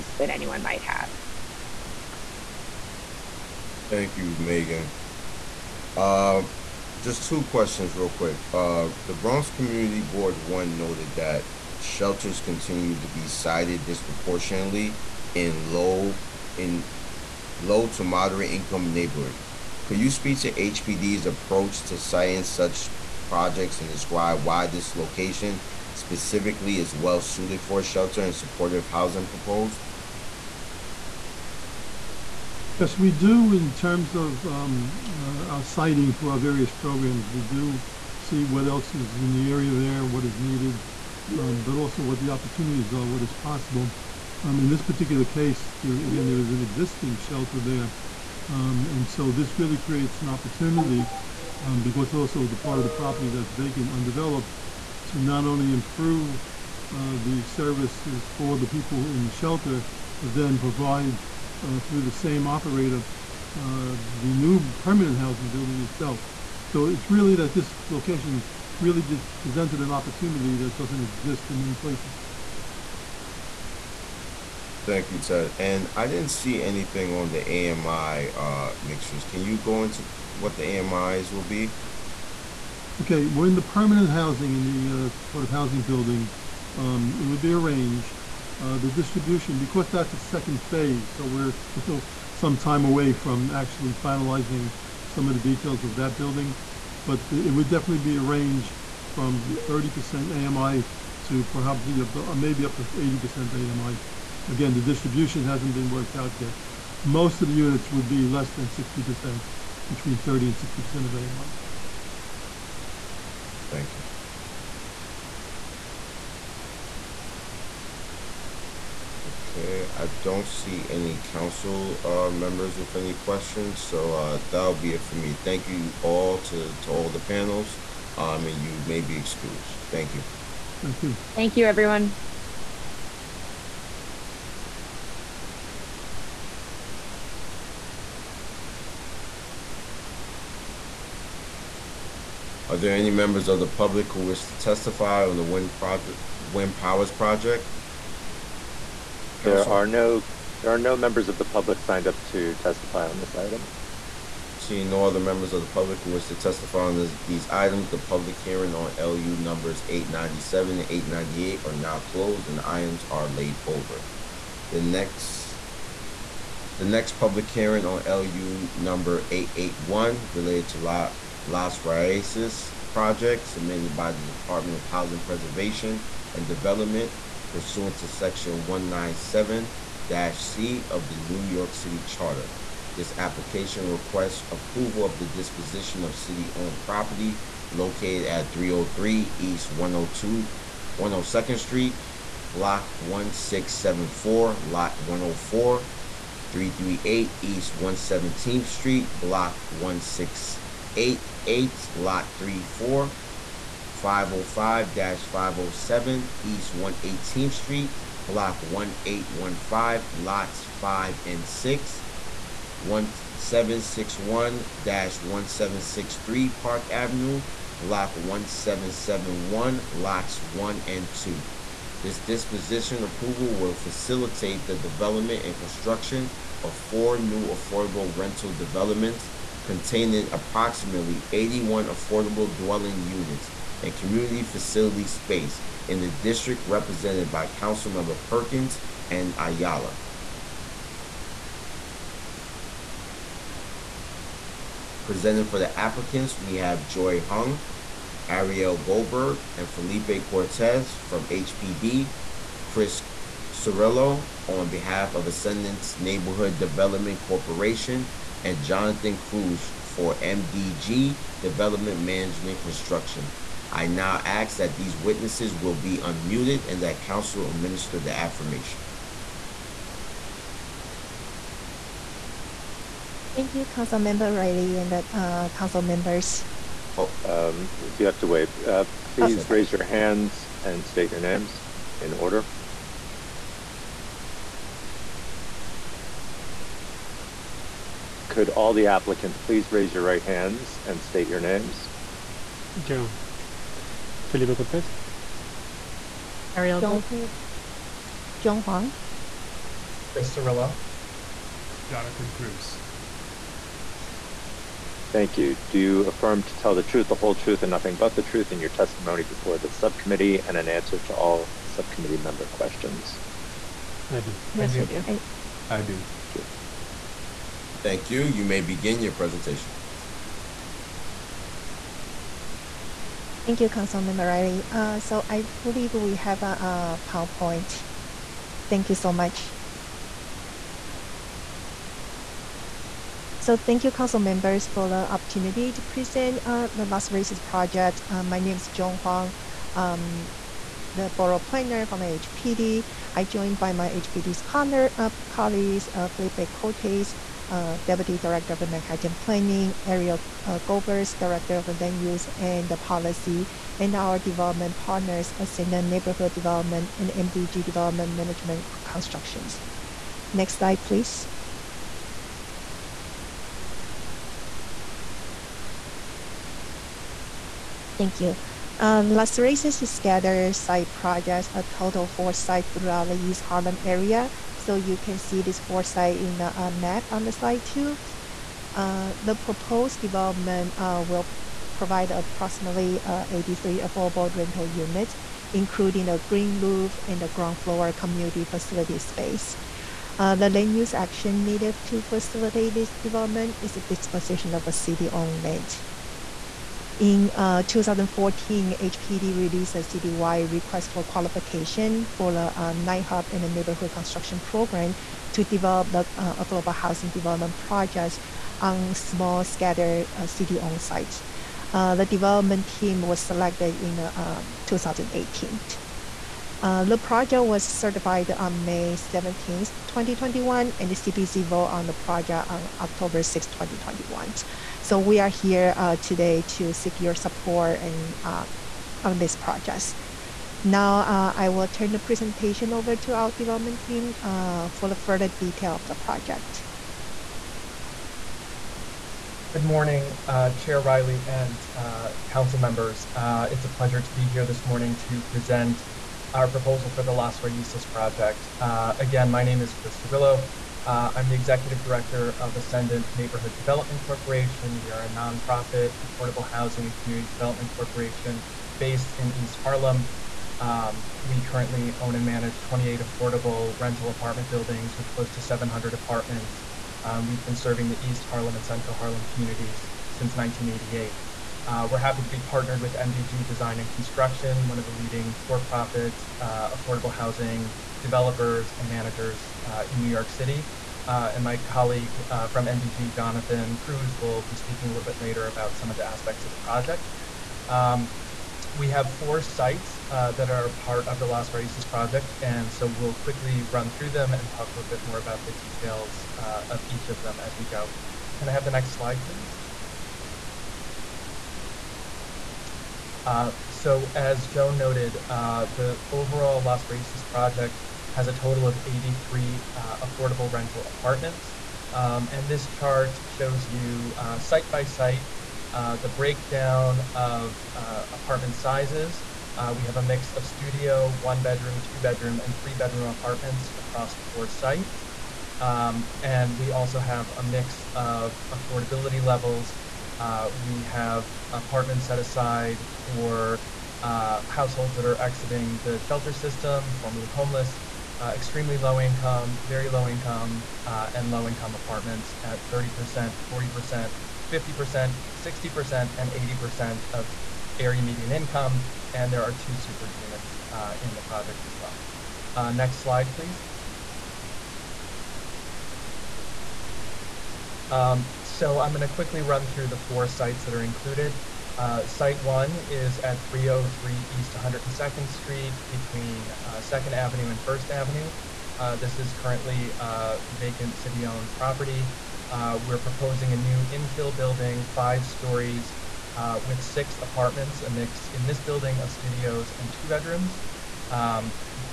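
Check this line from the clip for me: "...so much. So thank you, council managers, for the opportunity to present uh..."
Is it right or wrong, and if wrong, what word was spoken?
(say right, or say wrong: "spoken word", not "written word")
wrong: "members", not "managers".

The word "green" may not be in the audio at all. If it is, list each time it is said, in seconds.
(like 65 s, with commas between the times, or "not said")
386 s.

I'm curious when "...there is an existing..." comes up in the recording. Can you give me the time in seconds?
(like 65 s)
46 s.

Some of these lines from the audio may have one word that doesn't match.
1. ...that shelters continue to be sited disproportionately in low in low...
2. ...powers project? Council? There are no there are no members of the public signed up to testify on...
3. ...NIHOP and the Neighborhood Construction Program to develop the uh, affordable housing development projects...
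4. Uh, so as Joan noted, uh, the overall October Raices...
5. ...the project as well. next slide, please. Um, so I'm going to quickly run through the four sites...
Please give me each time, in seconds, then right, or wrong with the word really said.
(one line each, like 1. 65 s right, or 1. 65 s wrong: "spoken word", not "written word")
1. 11 s right
2. 146 s right
3. 402 s right
4. 503 s wrong: "Las", not "October"
5. 551 s right.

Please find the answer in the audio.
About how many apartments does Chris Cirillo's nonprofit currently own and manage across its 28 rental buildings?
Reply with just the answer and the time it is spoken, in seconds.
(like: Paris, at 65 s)
700, at 465 s.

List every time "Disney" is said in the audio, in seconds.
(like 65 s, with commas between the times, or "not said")
not said.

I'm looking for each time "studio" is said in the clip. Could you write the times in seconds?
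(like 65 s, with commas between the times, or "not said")
520 s, 579 s.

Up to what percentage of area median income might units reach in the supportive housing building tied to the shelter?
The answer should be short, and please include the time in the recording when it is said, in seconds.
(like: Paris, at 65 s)
80% AMI, at 102 s.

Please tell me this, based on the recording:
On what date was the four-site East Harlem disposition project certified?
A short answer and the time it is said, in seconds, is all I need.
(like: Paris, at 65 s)
May 17, 2021, at 418 s.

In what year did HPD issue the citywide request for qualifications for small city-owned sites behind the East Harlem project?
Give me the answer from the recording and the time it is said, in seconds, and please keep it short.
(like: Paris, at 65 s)
2014, at 397 s.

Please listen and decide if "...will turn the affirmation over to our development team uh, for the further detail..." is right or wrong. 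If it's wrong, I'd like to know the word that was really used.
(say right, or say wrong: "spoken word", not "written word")
wrong: "presentation", not "affirmation".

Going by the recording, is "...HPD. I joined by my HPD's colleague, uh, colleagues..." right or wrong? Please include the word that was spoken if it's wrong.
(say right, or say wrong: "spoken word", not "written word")
right.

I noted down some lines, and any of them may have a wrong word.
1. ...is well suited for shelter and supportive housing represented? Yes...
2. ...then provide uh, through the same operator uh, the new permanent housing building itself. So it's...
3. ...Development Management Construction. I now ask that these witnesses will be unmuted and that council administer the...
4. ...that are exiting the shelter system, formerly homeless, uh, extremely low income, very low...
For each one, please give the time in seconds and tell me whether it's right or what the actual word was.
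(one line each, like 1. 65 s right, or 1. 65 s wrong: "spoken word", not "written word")
1. 26 s wrong: "proposed", not "represented"
2. 60 s right
3. 261 s right
4. 534 s right.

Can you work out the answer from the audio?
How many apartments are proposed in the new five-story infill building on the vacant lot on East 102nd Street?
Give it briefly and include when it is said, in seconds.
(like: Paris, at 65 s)
6, at 576 s.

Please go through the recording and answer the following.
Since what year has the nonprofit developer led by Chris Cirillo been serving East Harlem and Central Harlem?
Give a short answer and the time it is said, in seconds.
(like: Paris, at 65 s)
1988, at 470 s.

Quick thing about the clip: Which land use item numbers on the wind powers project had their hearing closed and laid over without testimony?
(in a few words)
897 and 898.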